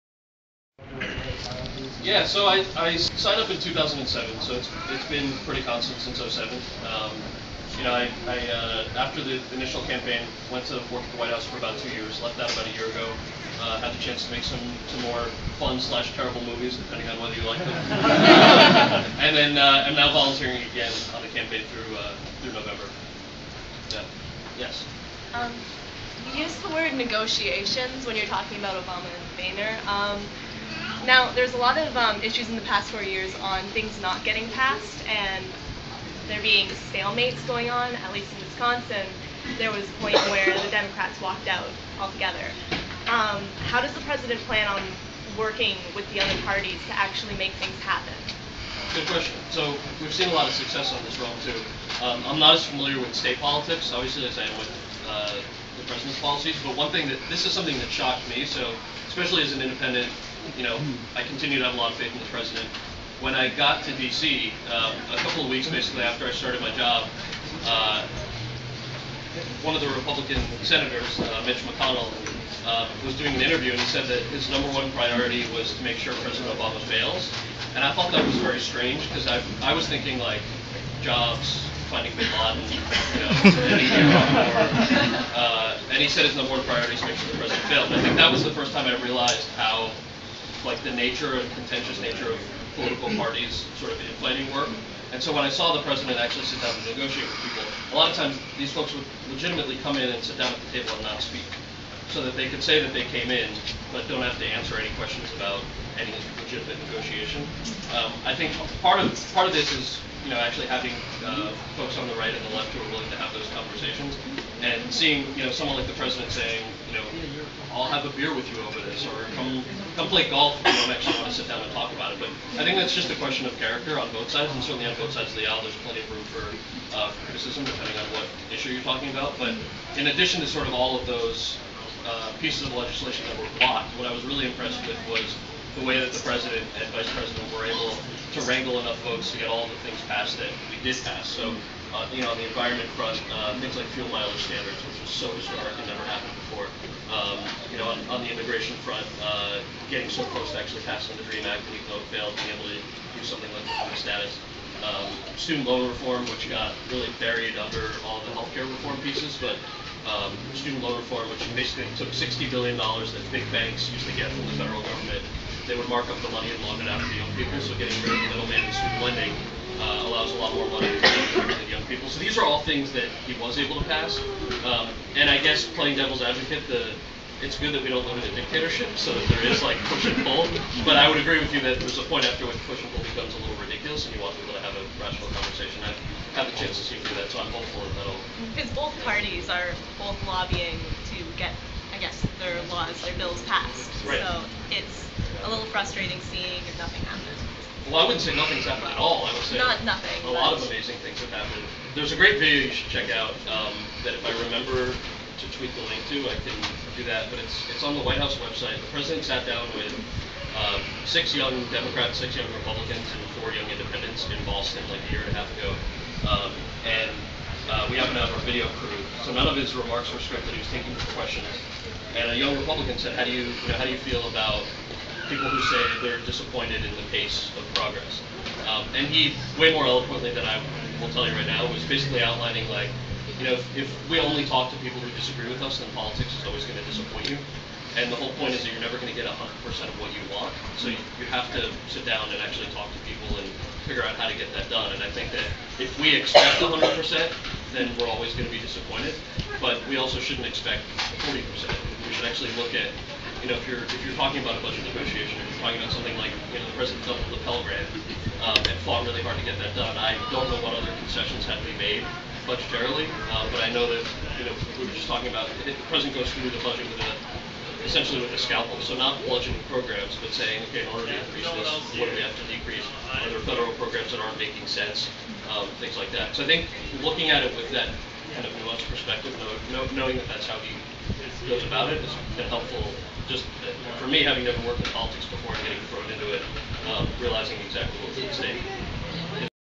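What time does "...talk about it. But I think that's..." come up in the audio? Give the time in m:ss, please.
2:01.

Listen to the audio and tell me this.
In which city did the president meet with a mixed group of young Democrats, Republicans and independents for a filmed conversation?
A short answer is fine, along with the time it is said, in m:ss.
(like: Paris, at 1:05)
Boston, at 3:34.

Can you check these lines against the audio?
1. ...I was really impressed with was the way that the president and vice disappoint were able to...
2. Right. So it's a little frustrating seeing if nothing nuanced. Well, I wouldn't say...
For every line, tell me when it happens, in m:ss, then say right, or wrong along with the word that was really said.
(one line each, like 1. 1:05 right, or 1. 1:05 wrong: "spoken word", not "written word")
1. 2:14 wrong: "president", not "disappoint"
2. 3:14 wrong: "happened", not "nuanced".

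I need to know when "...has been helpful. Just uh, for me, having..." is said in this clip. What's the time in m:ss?
4:42.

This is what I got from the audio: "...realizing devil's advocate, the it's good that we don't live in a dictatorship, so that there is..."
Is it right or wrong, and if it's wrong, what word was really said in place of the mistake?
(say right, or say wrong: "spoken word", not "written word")
wrong: "playing", not "realizing".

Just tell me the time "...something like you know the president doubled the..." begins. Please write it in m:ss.
4:15.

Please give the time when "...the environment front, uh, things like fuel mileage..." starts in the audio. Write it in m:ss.
2:22.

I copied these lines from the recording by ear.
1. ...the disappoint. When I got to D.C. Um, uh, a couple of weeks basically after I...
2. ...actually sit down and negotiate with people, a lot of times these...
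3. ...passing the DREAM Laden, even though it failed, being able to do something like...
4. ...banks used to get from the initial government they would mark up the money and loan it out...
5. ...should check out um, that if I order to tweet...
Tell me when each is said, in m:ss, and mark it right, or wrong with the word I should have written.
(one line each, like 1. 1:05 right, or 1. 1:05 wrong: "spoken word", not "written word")
1. 1:02 wrong: "president", not "disappoint"
2. 1:36 right
3. 2:30 wrong: "Act", not "Laden"
4. 2:43 wrong: "federal", not "initial"
5. 3:22 wrong: "remember", not "order".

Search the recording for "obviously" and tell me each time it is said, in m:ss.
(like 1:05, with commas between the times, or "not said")
0:53.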